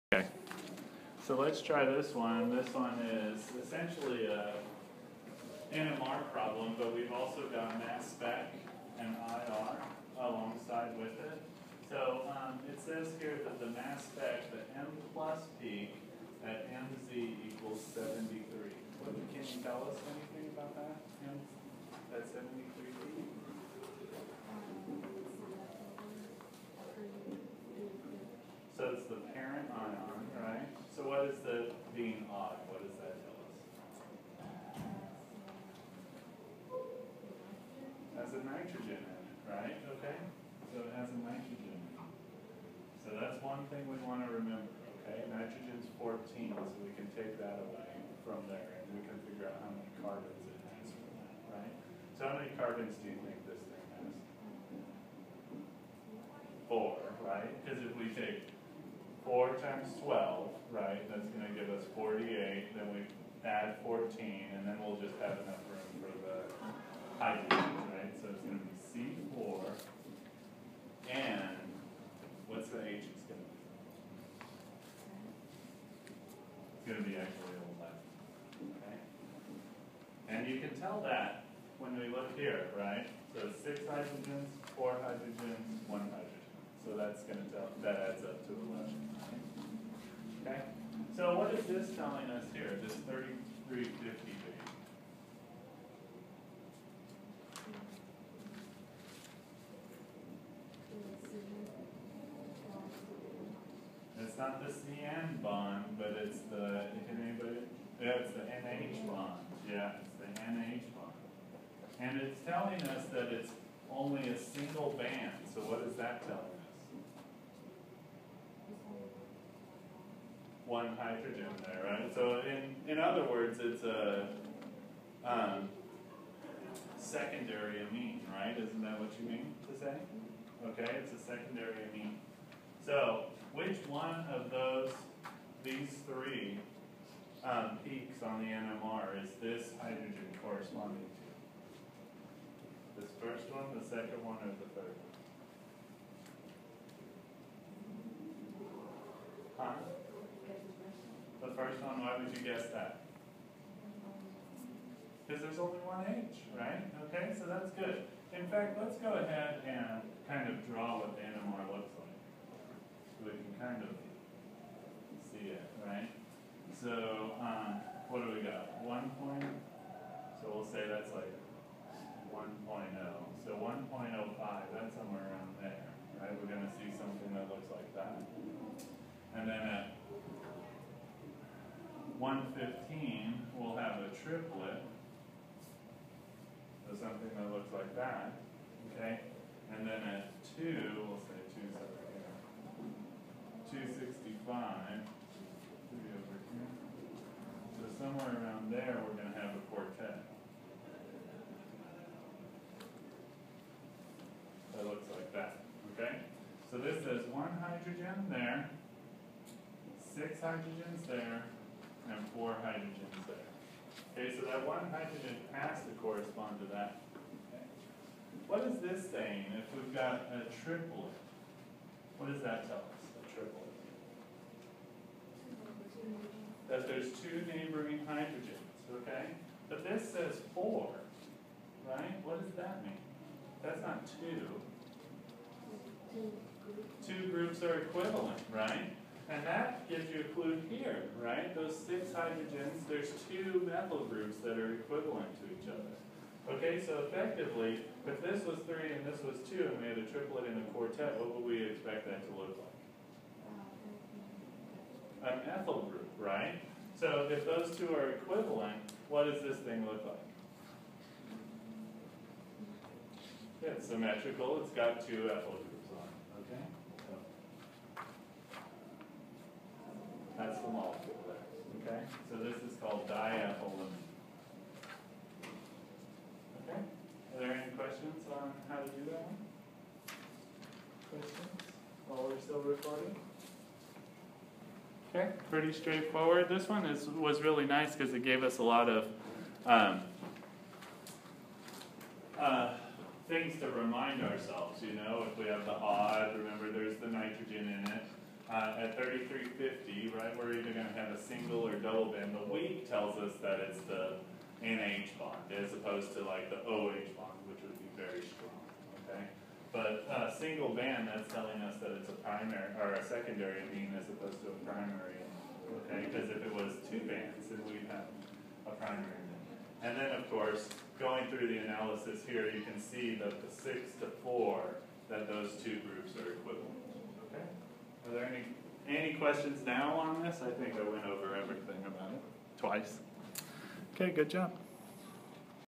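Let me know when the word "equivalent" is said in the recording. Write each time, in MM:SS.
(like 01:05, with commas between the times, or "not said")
03:57, 04:04, 04:18, 05:26.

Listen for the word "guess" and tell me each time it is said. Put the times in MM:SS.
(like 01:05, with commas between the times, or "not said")
02:32.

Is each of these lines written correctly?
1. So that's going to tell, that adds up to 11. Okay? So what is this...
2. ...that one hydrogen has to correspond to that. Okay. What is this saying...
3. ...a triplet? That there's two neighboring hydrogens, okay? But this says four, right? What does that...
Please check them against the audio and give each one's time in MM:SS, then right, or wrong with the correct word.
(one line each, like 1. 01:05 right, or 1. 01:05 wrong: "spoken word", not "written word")
1. 01:26 right
2. 03:34 right
3. 03:43 right.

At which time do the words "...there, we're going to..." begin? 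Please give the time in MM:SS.
03:18.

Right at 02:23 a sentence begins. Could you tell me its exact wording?
This first one, the second one, or the third one?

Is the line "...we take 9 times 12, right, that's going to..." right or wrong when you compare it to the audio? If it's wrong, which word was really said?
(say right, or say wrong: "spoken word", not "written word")
wrong: "4", not "9".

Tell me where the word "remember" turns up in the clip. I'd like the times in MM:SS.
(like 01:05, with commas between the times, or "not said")
00:44, 04:56.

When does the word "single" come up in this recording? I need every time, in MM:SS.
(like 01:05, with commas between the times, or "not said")
01:54, 05:01, 05:10.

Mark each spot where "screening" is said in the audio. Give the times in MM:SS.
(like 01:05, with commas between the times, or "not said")
not said.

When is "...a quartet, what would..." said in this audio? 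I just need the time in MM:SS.
04:10.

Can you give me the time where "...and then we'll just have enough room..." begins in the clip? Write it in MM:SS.
01:04.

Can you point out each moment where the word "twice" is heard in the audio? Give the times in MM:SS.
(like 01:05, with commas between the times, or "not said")
05:32.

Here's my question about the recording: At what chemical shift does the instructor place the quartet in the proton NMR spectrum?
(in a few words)
2.65.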